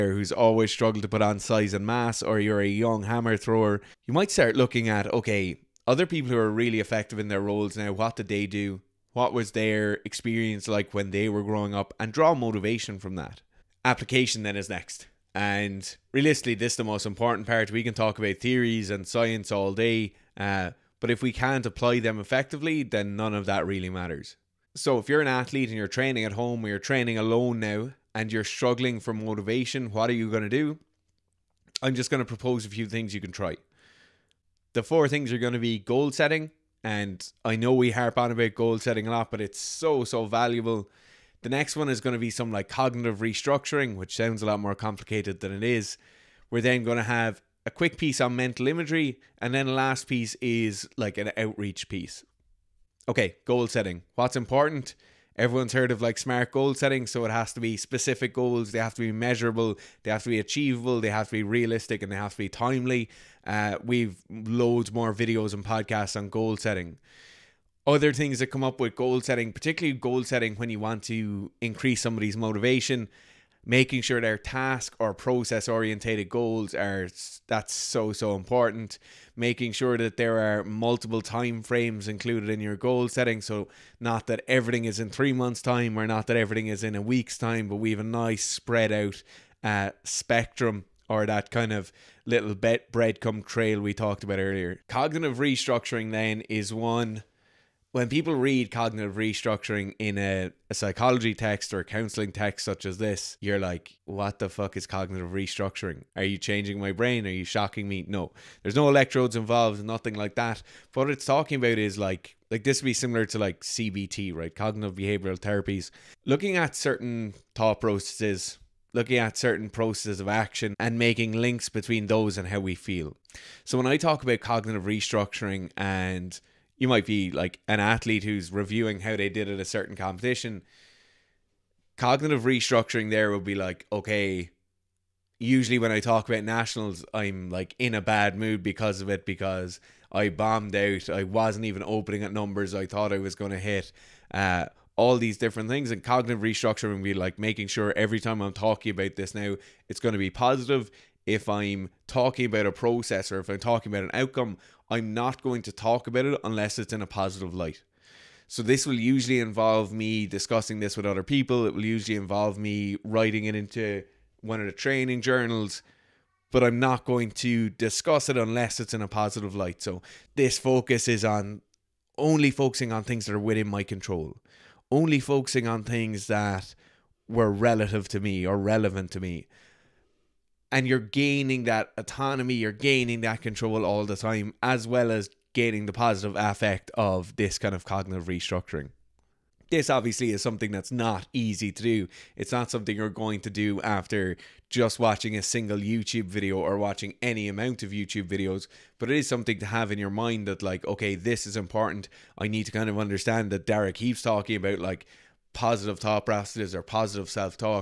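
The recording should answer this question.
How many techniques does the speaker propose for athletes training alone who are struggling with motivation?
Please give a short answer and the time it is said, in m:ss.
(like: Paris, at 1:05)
4, at 0:34.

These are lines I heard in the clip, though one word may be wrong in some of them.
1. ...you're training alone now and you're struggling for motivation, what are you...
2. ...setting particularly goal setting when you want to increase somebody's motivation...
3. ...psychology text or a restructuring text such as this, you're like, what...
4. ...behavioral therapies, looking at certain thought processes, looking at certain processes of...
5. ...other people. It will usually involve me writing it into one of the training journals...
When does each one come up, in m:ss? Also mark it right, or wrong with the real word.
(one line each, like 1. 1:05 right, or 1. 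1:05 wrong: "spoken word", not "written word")
1. 0:26 right
2. 1:09 right
3. 1:40 wrong: "counseling", not "restructuring"
4. 1:54 right
5. 2:41 right.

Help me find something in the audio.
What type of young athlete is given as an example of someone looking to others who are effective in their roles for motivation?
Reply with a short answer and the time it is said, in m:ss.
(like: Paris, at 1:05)
Hammer thrower, at 0:03.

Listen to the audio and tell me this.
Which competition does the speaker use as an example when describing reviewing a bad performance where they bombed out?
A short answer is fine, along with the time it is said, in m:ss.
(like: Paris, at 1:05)
Nationals, at 2:16.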